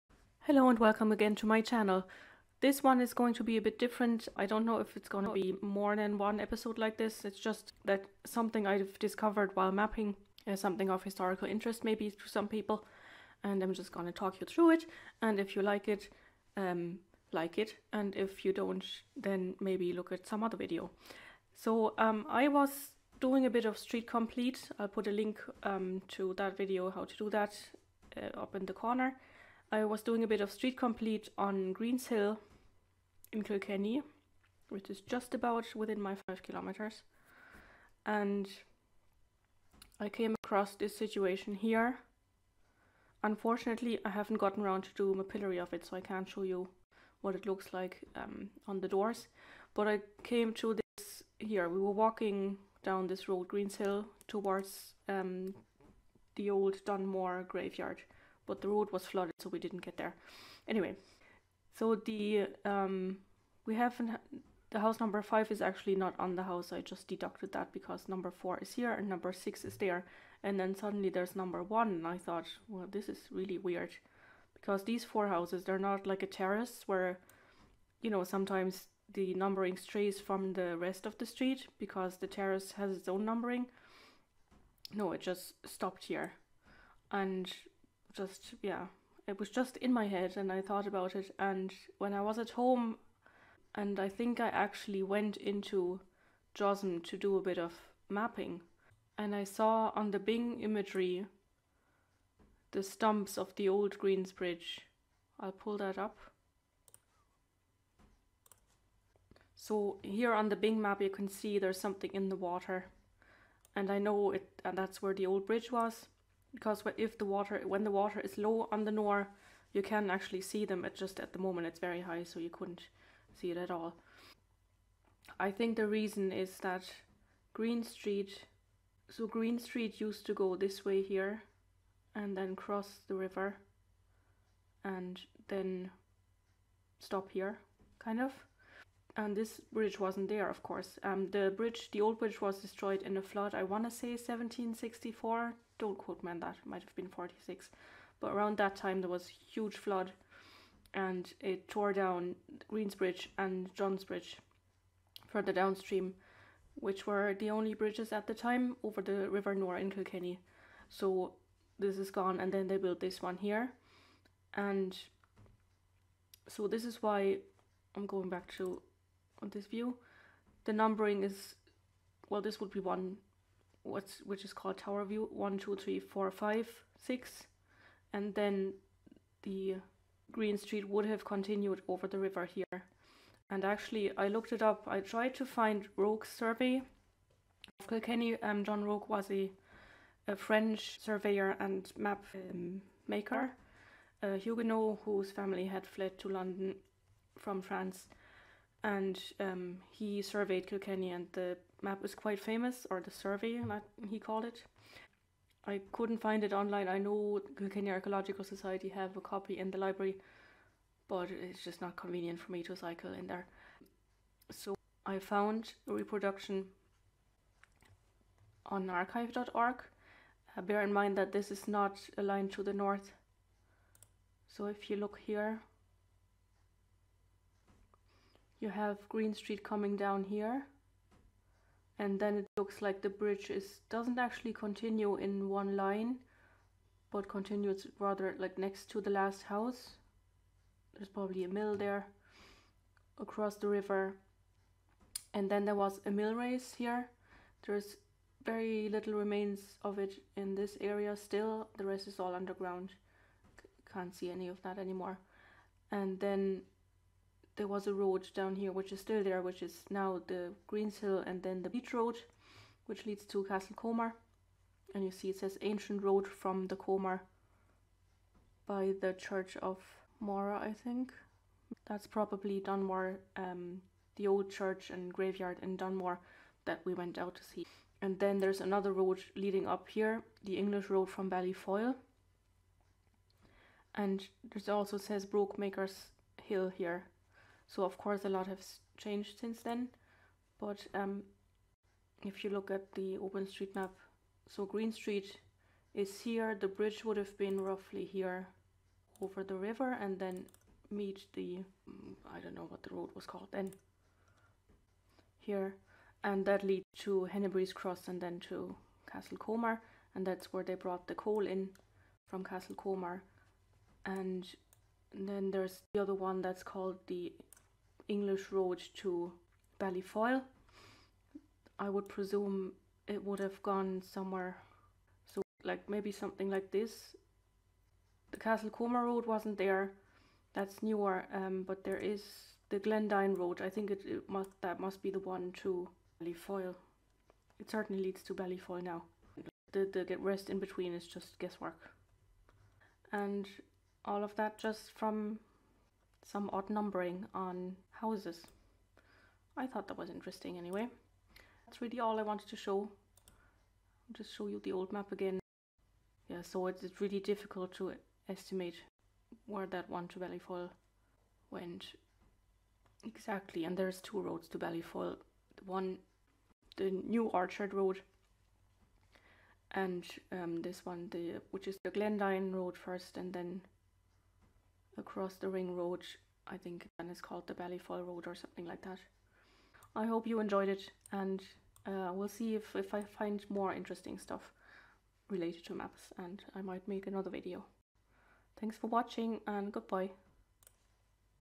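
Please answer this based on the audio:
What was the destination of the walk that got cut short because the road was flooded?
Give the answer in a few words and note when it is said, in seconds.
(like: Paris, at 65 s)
Dunmore graveyard, at 56 s.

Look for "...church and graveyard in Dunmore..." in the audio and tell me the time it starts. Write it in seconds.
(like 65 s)
274 s.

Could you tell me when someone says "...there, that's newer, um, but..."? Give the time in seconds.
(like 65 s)
329 s.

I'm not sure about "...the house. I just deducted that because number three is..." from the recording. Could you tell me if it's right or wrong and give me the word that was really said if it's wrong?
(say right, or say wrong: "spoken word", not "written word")
wrong: "four", not "three".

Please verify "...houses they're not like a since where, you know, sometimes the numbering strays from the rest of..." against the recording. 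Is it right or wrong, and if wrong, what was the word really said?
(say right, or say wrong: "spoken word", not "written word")
wrong: "terrace", not "since".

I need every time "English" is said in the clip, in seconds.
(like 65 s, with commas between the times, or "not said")
280 s, 318 s.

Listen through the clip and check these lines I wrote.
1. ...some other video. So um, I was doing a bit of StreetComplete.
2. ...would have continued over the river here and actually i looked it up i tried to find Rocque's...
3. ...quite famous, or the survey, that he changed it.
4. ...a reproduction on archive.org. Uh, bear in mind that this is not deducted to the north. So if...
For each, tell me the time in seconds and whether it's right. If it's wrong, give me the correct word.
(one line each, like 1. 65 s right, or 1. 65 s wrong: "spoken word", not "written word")
1. 20 s right
2. 180 s right
3. 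202 s wrong: "called", not "changed"
4. 215 s wrong: "aligned", not "deducted".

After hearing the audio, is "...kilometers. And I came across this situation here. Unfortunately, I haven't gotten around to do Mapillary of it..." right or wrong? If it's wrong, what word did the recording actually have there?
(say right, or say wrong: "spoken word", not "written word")
right.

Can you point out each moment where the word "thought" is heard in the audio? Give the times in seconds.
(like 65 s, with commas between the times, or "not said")
72 s, 90 s, 349 s.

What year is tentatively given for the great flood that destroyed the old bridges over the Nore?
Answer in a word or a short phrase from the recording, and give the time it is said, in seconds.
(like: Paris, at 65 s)
1764, at 144 s.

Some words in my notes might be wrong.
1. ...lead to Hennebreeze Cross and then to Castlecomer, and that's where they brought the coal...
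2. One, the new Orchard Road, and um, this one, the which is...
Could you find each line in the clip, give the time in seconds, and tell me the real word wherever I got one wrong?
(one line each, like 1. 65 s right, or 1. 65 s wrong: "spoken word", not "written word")
1. 306 s right
2. 365 s right.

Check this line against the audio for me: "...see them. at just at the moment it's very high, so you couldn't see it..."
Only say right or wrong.
right.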